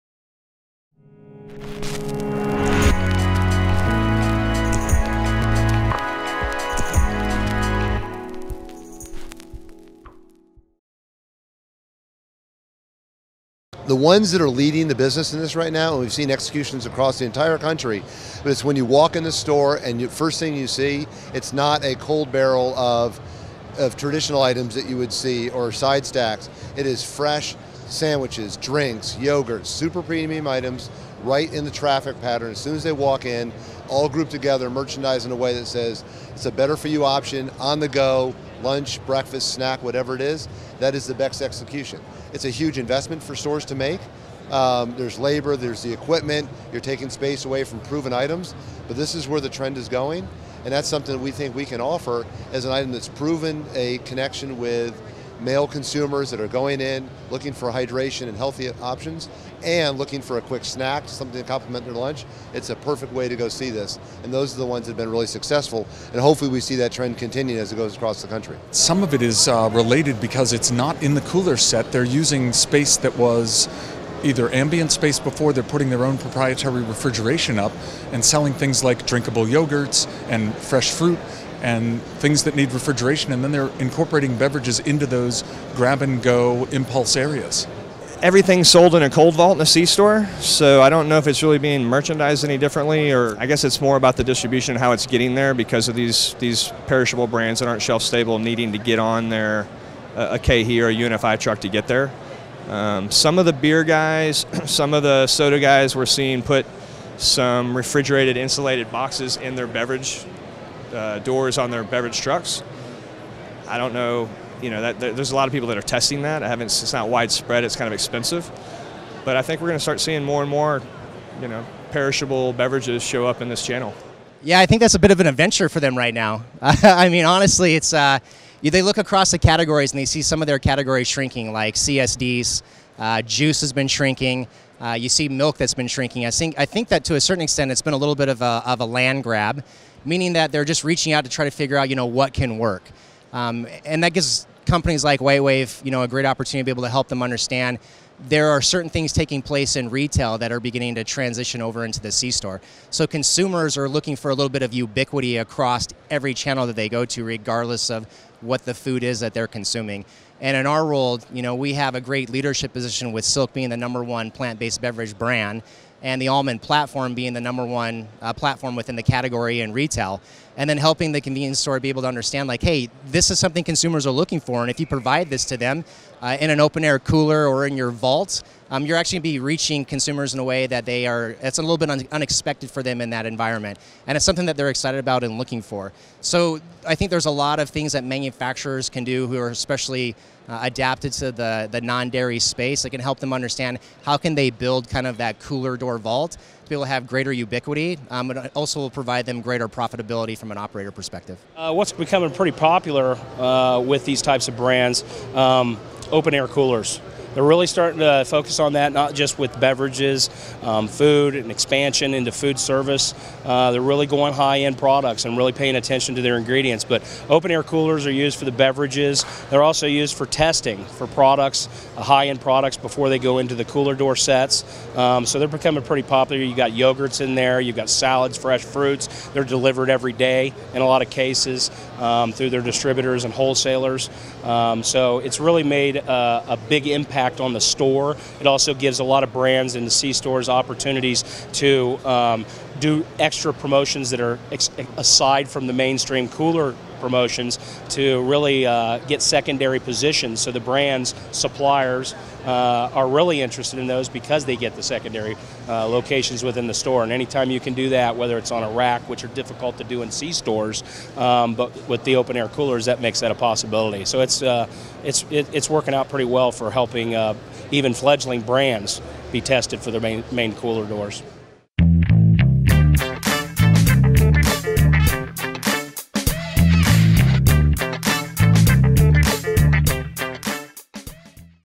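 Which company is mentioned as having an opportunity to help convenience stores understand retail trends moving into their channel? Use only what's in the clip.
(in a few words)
WhiteWave.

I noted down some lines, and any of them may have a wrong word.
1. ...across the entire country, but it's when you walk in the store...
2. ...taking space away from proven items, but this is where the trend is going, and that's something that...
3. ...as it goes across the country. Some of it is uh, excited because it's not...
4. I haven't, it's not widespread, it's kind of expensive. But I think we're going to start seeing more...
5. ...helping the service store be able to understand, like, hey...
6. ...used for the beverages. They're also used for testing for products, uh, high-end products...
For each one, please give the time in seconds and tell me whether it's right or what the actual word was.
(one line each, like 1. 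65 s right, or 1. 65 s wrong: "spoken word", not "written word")
1. 16 s right
2. 46 s right
3. 67 s wrong: "related", not "excited"
4. 116 s right
5. 170 s wrong: "convenience", not "service"
6. 218 s right.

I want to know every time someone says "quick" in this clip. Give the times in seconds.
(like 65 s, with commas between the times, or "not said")
60 s.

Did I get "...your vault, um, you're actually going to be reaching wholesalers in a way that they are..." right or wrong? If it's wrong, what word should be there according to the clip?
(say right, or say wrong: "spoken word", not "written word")
wrong: "consumers", not "wholesalers".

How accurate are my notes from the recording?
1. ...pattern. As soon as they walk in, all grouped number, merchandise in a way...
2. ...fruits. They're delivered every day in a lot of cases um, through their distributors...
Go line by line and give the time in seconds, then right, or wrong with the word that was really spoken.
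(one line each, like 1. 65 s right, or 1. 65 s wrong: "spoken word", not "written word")
1. 32 s wrong: "together", not "number"
2. 228 s right.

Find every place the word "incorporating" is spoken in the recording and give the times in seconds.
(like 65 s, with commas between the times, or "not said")
83 s.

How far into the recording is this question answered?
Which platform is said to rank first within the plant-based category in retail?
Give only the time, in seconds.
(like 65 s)
166 s.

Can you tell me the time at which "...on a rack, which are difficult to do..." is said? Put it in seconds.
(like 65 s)
258 s.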